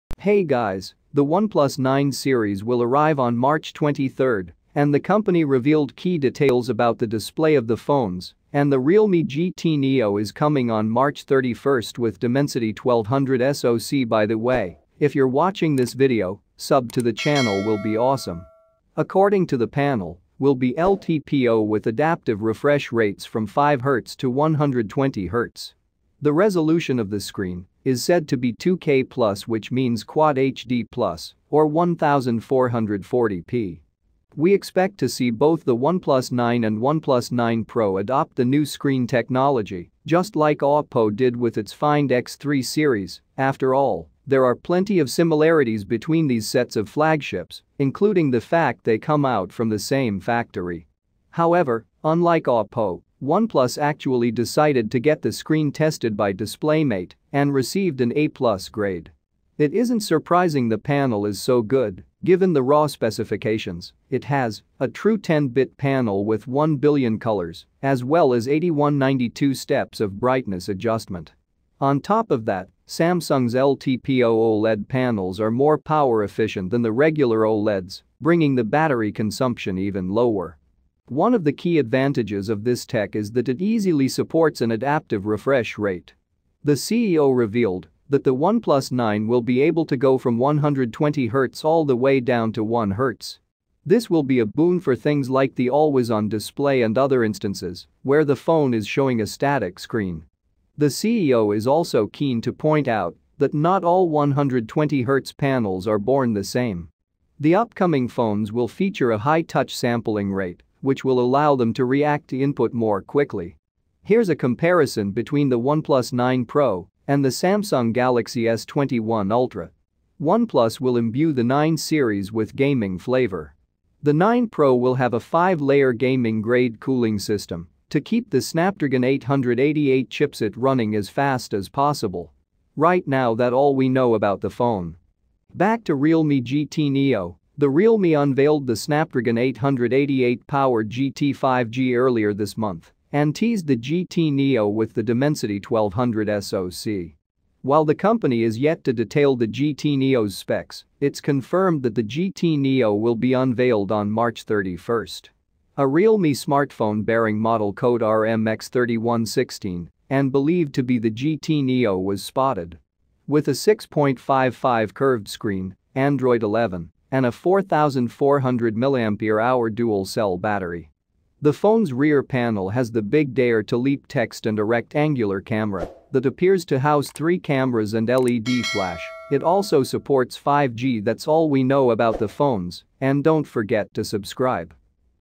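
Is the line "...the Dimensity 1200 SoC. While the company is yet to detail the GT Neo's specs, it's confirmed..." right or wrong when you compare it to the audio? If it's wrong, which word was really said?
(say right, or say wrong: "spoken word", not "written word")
right.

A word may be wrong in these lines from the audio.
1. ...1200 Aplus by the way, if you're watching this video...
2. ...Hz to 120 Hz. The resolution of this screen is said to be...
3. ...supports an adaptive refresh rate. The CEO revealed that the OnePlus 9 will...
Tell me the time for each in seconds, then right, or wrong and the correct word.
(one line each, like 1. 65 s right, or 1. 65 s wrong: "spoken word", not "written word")
1. 12 s wrong: "SoC", not "Aplus"
2. 23 s right
3. 84 s right.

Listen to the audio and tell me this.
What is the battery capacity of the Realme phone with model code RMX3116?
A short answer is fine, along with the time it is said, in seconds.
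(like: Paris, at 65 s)
4,400 mAh, at 167 s.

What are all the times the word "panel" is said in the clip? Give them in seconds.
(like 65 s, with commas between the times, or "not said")
19 s, 60 s, 65 s, 74 s, 105 s, 172 s.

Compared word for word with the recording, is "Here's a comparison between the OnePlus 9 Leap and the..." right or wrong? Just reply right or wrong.
wrong.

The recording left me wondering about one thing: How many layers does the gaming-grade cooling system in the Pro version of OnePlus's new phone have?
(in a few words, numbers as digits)
5.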